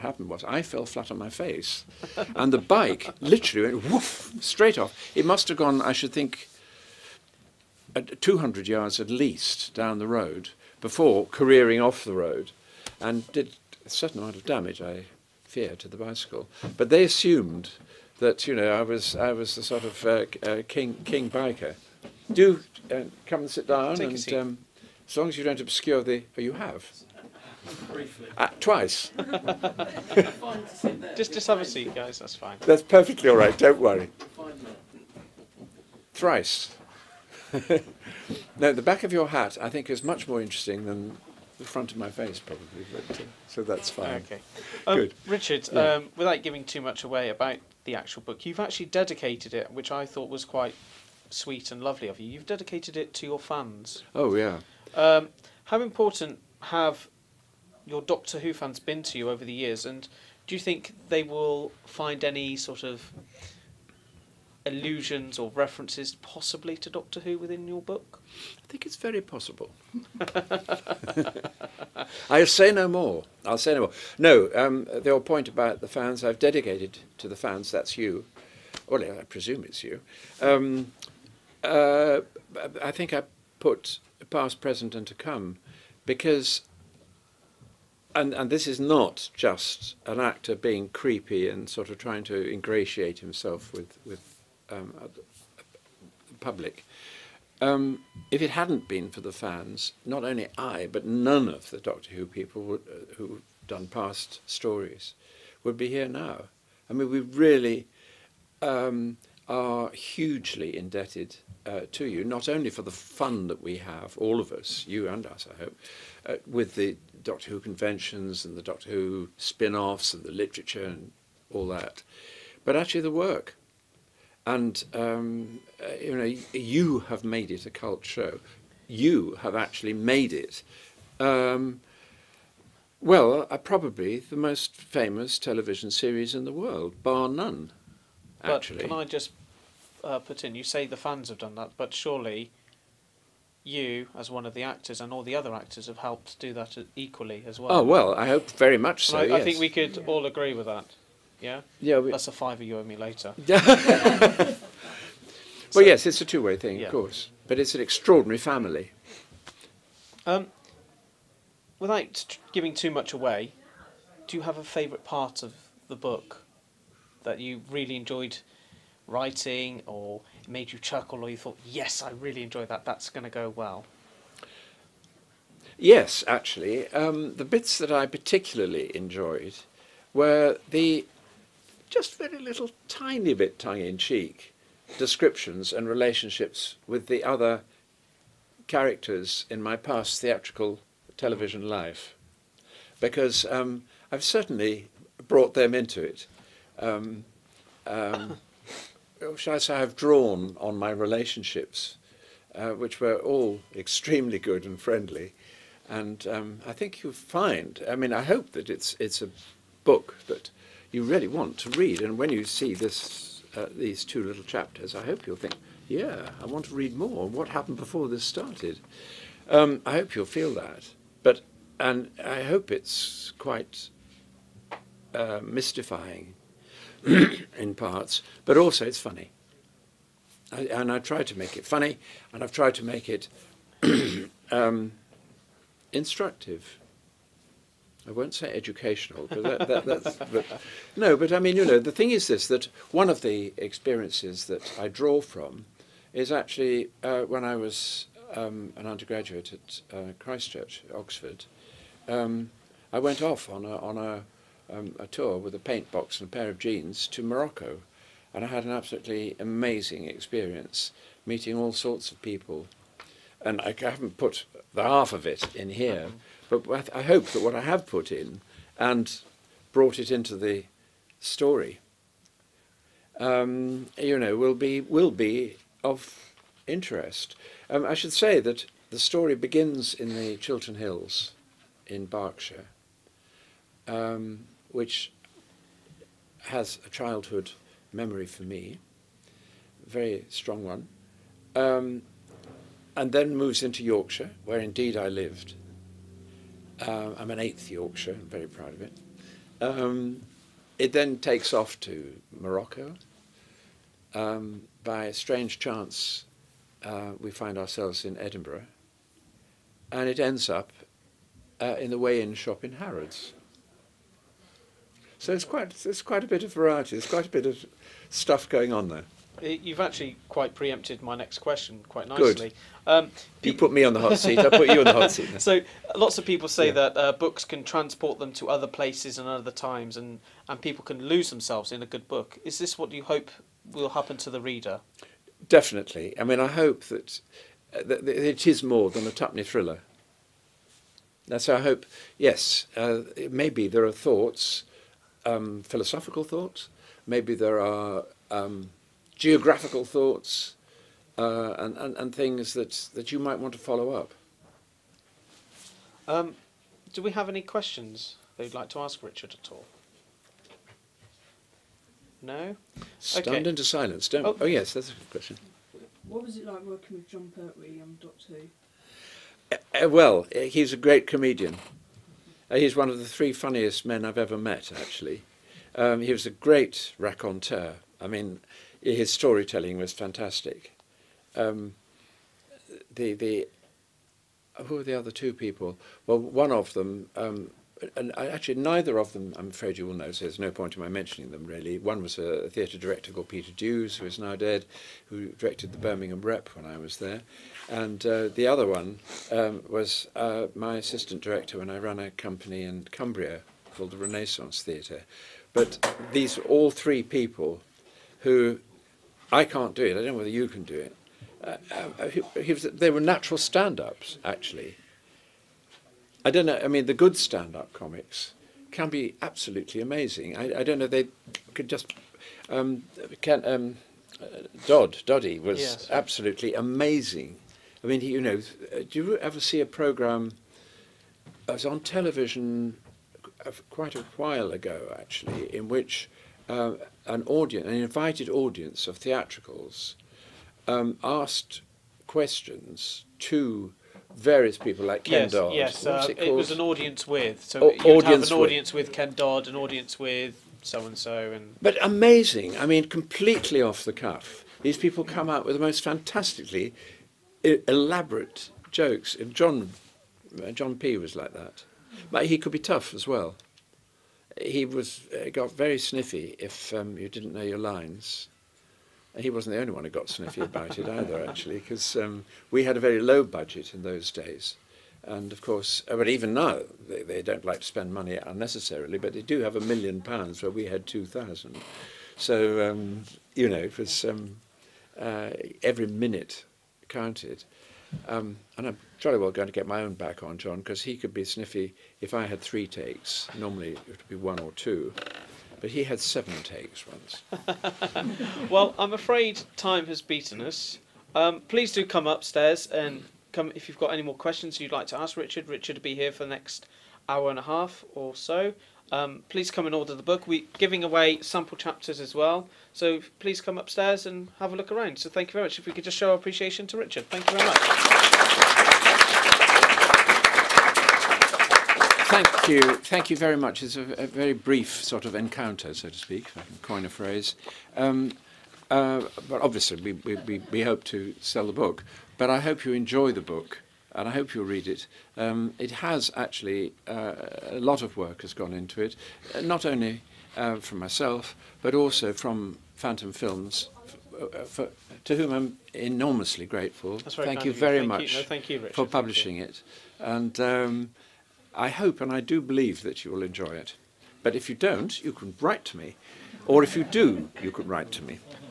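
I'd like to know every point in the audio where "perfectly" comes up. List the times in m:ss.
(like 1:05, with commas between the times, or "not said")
0:32.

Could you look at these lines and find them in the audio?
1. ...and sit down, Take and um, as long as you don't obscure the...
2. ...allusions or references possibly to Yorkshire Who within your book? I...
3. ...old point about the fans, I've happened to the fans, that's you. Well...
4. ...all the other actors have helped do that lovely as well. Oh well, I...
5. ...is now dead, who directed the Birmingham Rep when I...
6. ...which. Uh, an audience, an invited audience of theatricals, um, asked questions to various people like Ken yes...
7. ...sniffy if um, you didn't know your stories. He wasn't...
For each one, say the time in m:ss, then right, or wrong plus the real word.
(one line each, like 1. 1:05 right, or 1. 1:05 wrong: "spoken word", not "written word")
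1. 0:23 right
2. 1:04 wrong: "Doctor", not "Yorkshire"
3. 1:15 wrong: "dedicated", not "happened"
4. 2:25 wrong: "equally", not "lovely"
5. 6:34 right
6. 7:15 right
7. 7:45 wrong: "lines", not "stories".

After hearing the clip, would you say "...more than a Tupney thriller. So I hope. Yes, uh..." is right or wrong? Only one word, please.
right.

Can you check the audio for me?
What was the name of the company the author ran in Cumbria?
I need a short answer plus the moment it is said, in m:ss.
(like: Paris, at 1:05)
Renaissance Theatre, at 6:43.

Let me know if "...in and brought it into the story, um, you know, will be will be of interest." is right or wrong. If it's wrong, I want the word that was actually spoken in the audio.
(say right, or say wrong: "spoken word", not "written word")
right.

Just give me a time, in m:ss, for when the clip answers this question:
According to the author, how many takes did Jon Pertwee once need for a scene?
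8:15.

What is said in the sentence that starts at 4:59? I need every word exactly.
Um, it then takes off to Morocco.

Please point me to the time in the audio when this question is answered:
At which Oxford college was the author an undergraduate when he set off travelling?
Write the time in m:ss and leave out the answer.
4:10.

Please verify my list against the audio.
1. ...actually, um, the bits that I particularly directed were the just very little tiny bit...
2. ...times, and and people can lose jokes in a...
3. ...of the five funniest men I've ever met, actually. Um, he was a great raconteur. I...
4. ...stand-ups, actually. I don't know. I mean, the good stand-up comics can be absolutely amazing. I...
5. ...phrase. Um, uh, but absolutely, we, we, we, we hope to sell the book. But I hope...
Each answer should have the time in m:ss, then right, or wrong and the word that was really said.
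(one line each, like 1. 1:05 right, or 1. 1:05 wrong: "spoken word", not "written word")
1. 2:56 wrong: "enjoyed", not "directed"
2. 5:29 wrong: "themselves", not "jokes"
3. 6:12 wrong: "three", not "five"
4. 6:53 right
5. 8:46 wrong: "obviously", not "absolutely".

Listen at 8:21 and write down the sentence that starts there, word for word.
Um, please do come upstairs and come if you've got any more questions you'd like to ask Richard.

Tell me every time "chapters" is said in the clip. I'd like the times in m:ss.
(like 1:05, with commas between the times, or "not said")
3:34, 8:31.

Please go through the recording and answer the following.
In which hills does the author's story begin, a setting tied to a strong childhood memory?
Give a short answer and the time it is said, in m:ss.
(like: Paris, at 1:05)
Chiltern Hills, at 4:40.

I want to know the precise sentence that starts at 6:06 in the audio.
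What was it like working with Jon Pertwee on um, Doctor Who?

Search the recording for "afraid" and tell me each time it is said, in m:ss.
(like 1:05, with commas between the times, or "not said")
6:29, 8:18.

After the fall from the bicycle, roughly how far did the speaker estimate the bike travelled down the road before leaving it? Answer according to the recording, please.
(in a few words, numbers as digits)
200 yards.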